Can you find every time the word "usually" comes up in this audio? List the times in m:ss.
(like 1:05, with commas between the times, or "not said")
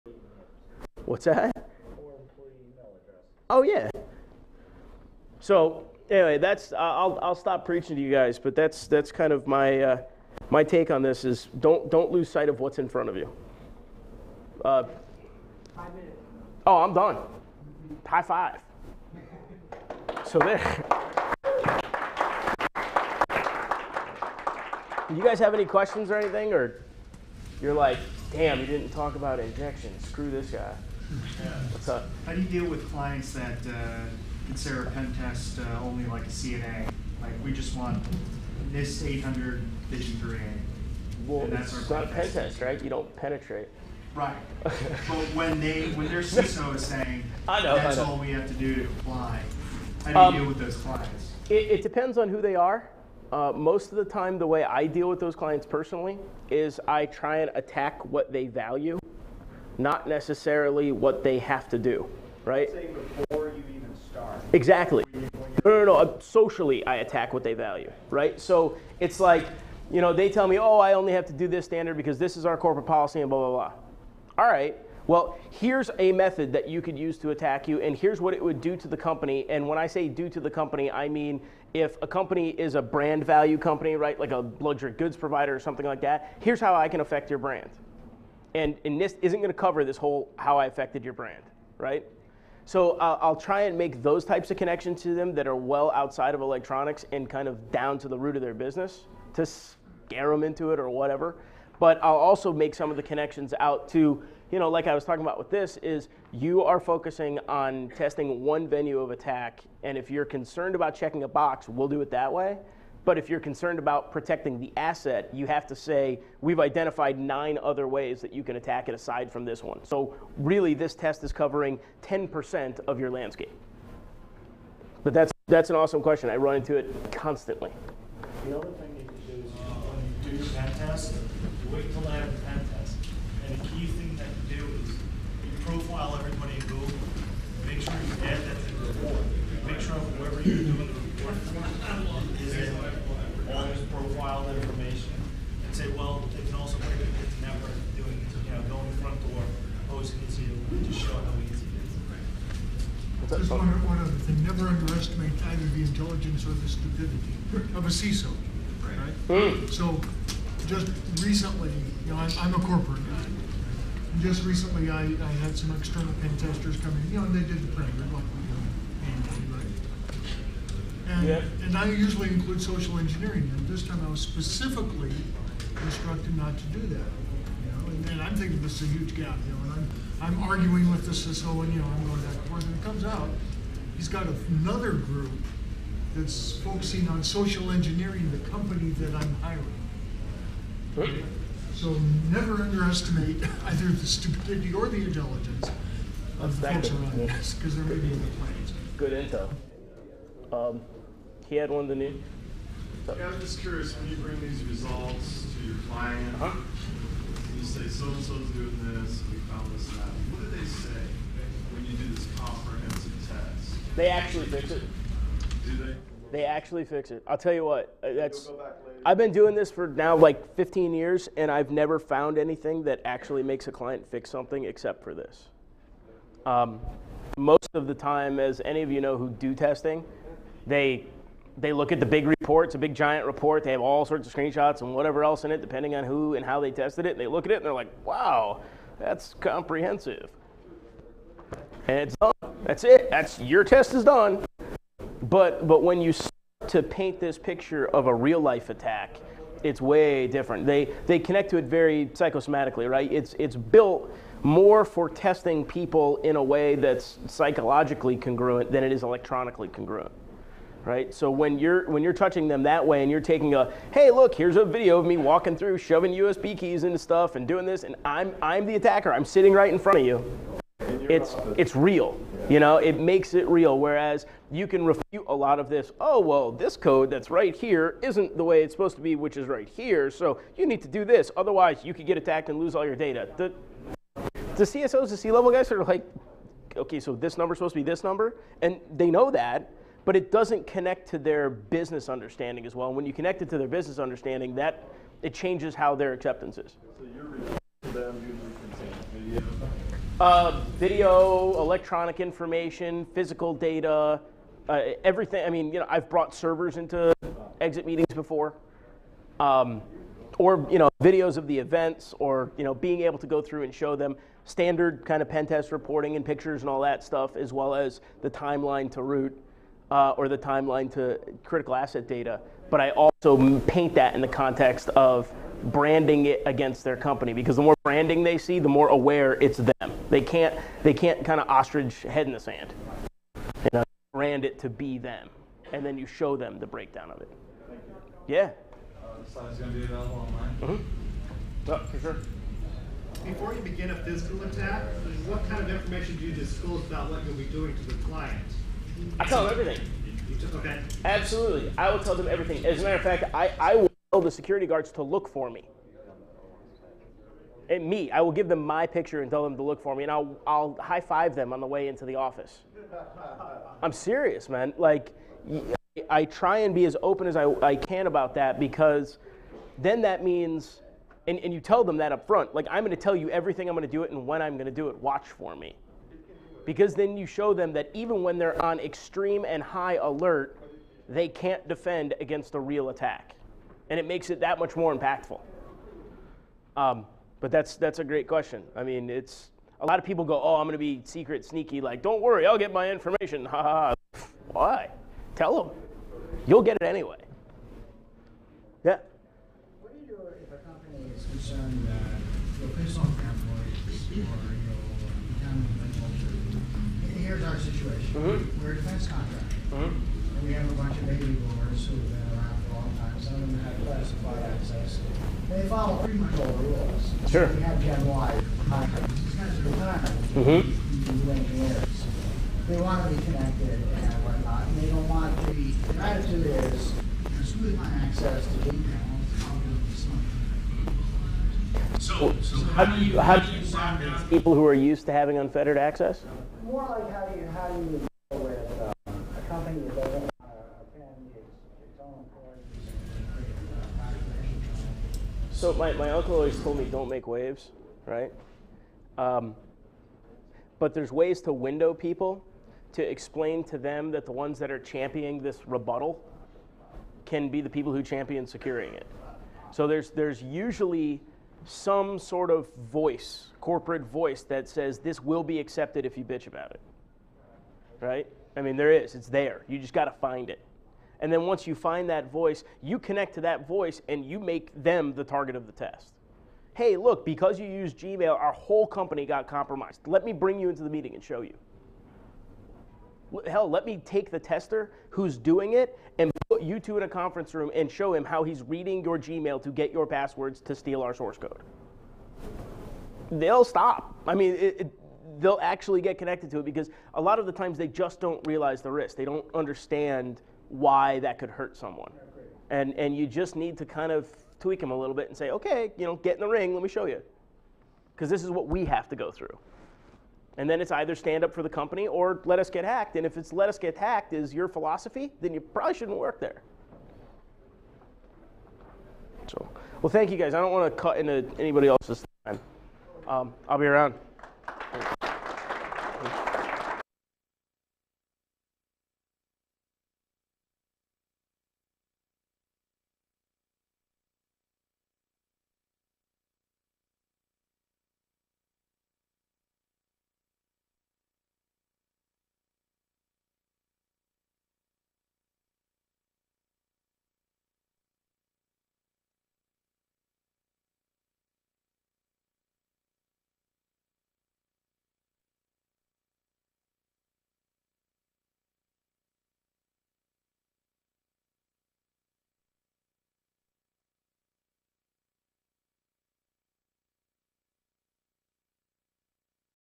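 2:51, 7:40.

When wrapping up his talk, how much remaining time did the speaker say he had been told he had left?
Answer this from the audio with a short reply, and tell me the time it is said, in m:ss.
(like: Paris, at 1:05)
5 minutes, at 0:15.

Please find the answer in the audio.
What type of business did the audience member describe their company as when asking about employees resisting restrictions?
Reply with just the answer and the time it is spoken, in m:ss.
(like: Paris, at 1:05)
defense contractor, at 6:48.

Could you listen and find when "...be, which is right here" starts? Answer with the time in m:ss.
4:39.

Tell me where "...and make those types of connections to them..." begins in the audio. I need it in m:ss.
1:33.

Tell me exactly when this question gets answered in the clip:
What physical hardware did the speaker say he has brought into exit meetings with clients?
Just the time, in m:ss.
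5:06.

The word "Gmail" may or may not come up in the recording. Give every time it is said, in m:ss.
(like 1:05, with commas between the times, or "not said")
7:57, 8:09.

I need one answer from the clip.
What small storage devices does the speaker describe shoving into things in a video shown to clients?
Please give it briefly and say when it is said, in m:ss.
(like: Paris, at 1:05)
USB keys, at 4:26.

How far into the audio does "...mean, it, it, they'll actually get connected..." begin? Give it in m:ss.
8:14.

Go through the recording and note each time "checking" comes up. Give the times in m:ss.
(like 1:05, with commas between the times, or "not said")
1:50.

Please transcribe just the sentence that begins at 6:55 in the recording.
They follow pretty much all the rules.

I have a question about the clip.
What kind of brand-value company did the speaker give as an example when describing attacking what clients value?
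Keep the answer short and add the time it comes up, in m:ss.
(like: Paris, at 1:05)
luxury goods provider, at 1:24.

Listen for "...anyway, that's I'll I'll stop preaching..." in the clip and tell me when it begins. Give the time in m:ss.
0:06.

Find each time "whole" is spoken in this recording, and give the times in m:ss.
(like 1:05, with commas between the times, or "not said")
1:29, 3:01, 7:58.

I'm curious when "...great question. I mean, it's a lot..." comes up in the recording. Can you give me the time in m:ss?
6:28.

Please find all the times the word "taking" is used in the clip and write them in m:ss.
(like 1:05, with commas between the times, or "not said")
4:23.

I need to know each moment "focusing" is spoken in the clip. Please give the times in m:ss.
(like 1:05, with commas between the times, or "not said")
1:46, 3:06.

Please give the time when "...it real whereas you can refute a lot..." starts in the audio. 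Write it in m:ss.
4:33.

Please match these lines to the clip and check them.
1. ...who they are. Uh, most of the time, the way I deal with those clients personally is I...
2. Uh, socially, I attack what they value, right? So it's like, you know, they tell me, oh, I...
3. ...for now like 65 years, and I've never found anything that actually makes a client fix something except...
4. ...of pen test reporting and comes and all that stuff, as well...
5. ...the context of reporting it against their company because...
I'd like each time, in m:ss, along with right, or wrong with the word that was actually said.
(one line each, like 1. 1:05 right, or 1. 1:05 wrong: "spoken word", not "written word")
1. 0:52 right
2. 1:05 right
3. 3:39 wrong: "15", not "65"
4. 5:15 wrong: "pictures", not "comes"
5. 5:24 wrong: "branding", not "reporting".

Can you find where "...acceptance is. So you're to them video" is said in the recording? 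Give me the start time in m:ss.
4:56.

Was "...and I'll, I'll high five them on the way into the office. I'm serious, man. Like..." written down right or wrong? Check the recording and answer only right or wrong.
right.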